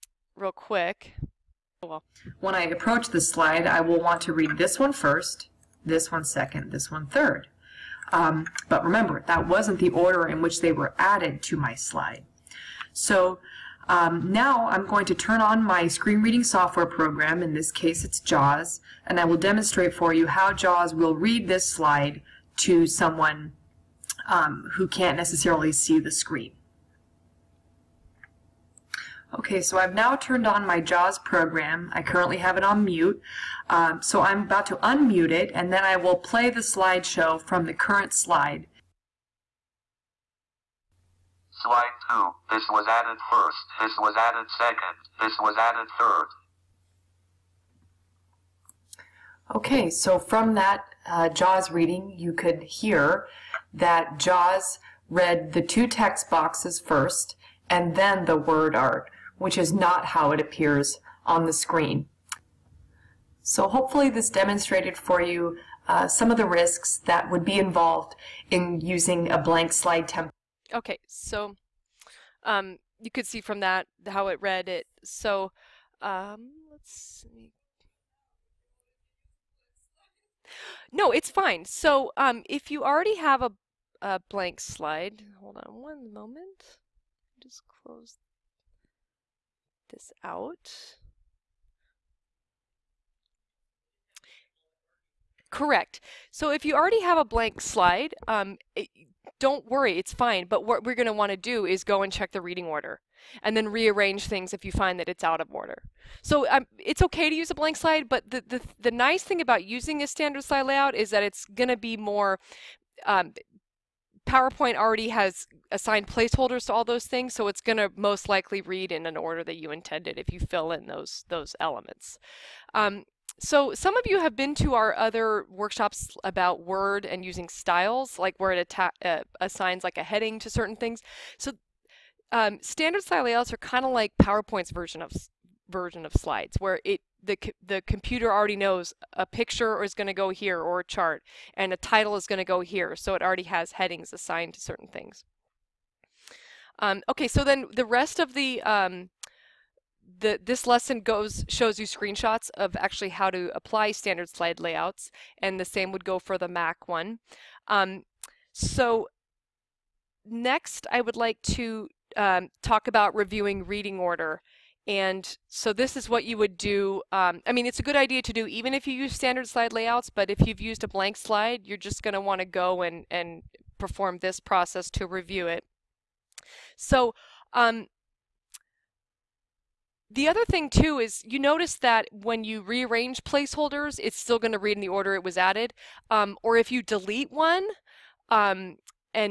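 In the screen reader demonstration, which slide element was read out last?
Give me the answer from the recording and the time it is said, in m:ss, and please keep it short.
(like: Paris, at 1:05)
word art, at 0:58.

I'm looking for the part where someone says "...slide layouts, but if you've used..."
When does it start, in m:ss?
2:49.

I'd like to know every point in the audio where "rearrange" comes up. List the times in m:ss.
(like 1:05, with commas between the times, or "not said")
1:43, 3:02.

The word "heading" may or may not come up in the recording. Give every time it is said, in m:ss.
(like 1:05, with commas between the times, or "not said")
2:10, 2:23.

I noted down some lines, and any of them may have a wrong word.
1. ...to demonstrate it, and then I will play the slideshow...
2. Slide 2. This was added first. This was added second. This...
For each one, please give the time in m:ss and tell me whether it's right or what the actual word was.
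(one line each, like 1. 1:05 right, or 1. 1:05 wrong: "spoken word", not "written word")
1. 0:34 wrong: "unmute", not "demonstrate"
2. 0:41 right.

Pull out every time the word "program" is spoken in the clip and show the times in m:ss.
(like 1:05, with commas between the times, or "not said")
0:16, 0:31.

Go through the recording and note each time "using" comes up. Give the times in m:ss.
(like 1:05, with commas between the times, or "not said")
1:08, 1:49, 2:07.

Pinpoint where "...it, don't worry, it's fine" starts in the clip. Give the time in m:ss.
1:38.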